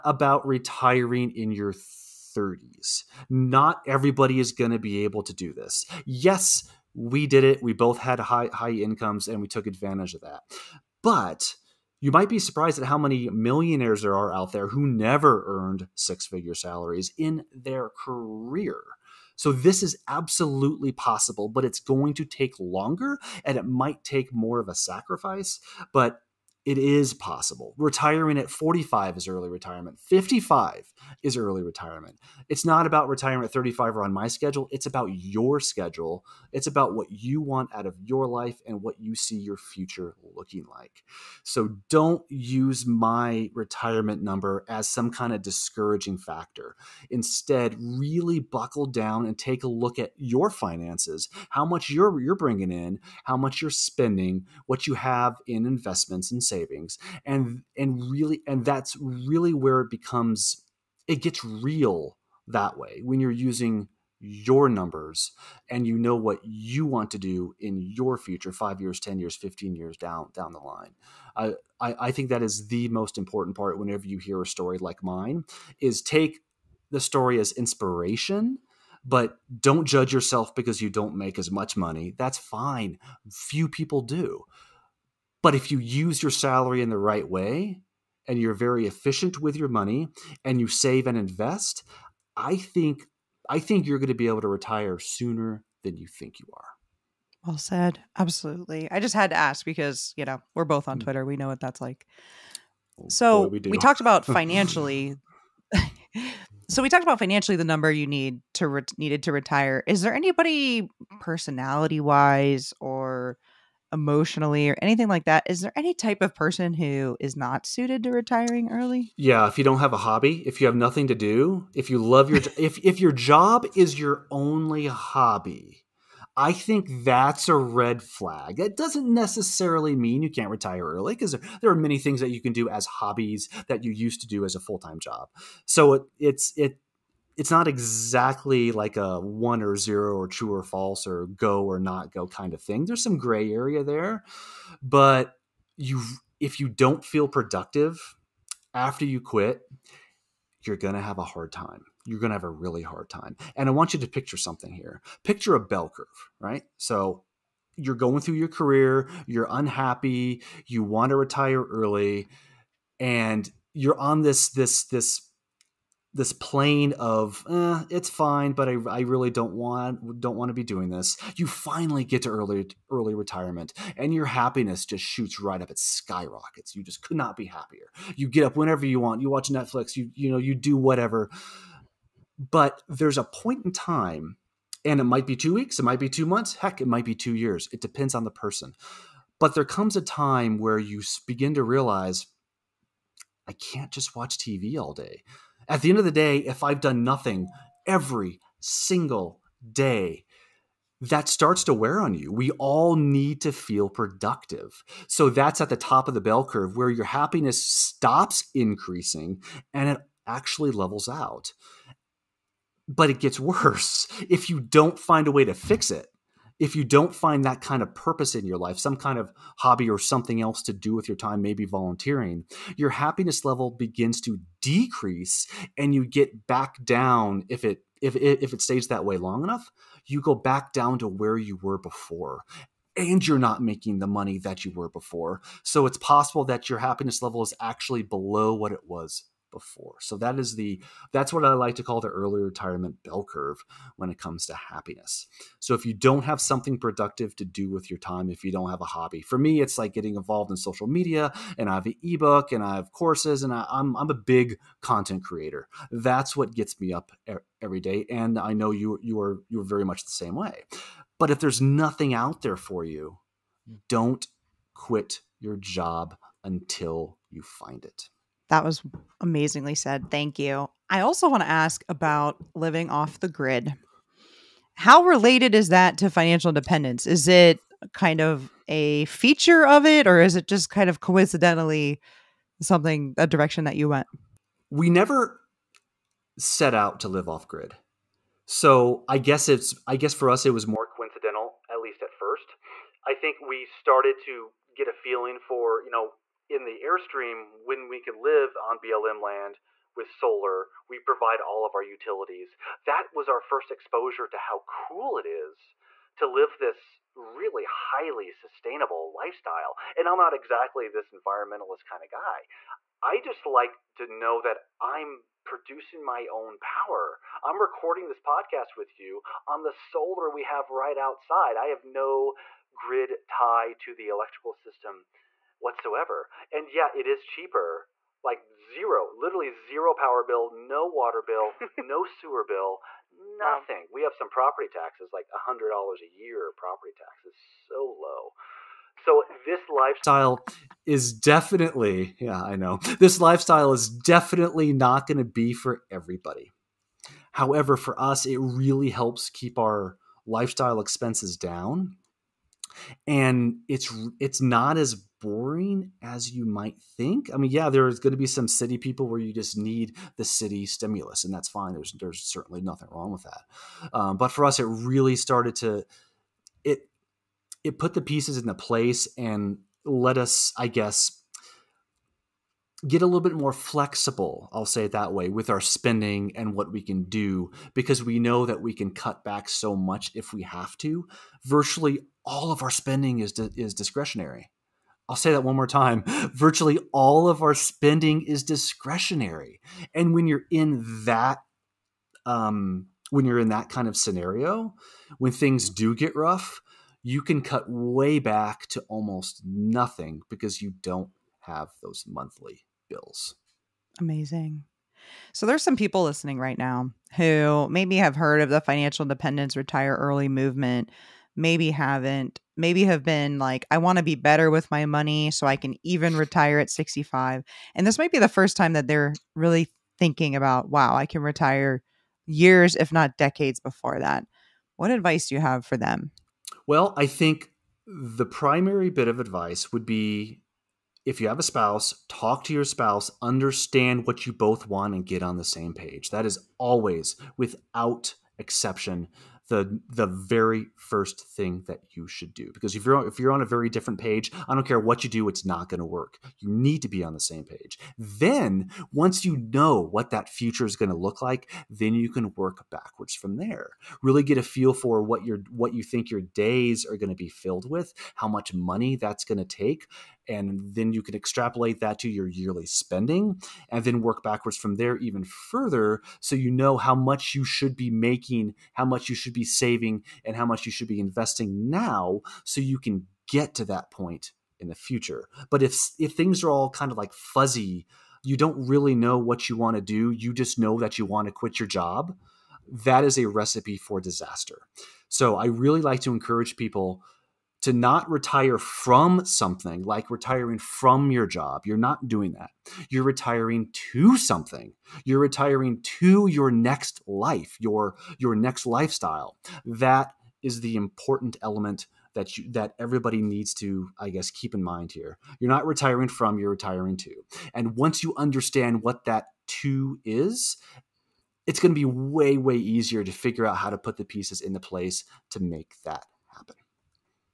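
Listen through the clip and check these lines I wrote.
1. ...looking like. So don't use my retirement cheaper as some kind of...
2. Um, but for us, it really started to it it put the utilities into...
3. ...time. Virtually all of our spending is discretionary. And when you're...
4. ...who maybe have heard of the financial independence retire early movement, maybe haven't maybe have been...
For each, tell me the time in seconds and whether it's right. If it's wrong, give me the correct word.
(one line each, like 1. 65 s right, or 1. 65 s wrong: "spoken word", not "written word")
1. 40 s wrong: "number", not "cheaper"
2. 363 s wrong: "pieces", not "utilities"
3. 385 s right
4. 407 s right.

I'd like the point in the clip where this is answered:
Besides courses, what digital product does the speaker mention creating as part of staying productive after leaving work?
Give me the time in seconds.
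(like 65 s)
252 s.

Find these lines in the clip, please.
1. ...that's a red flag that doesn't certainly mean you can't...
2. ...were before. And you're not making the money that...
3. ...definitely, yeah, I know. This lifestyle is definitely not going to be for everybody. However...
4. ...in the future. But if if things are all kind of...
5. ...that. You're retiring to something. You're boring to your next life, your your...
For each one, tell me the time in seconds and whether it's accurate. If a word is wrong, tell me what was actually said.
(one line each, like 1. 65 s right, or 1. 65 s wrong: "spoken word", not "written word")
1. 127 s wrong: "necessarily", not "certainly"
2. 231 s right
3. 341 s right
4. 474 s right
5. 492 s wrong: "retiring", not "boring".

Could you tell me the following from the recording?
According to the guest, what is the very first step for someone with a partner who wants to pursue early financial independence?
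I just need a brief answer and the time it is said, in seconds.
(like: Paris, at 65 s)
talk to your spouse, at 432 s.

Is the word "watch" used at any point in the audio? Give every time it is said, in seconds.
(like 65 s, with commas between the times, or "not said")
179 s, 194 s.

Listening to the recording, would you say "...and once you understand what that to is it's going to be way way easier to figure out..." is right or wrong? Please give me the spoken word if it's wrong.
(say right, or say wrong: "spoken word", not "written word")
right.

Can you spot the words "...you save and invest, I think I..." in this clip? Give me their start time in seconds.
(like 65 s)
90 s.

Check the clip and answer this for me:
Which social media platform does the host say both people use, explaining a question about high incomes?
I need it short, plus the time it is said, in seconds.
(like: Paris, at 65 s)
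Twitter, at 101 s.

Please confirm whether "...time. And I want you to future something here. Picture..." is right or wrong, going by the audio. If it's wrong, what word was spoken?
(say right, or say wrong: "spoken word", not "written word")
wrong: "picture", not "future".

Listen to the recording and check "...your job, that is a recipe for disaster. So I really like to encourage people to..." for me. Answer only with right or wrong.
right.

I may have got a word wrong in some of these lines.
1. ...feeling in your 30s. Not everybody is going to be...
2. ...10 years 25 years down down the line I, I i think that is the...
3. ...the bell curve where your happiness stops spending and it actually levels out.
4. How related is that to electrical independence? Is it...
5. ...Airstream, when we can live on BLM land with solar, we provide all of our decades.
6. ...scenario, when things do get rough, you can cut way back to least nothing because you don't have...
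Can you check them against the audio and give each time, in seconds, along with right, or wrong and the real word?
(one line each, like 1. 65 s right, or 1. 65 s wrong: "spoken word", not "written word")
1. 0 s wrong: "retiring", not "feeling"
2. 68 s wrong: "15", not "25"
3. 206 s wrong: "increasing", not "spending"
4. 274 s wrong: "financial", not "electrical"
5. 296 s wrong: "utilities", not "decades"
6. 393 s wrong: "almost", not "least".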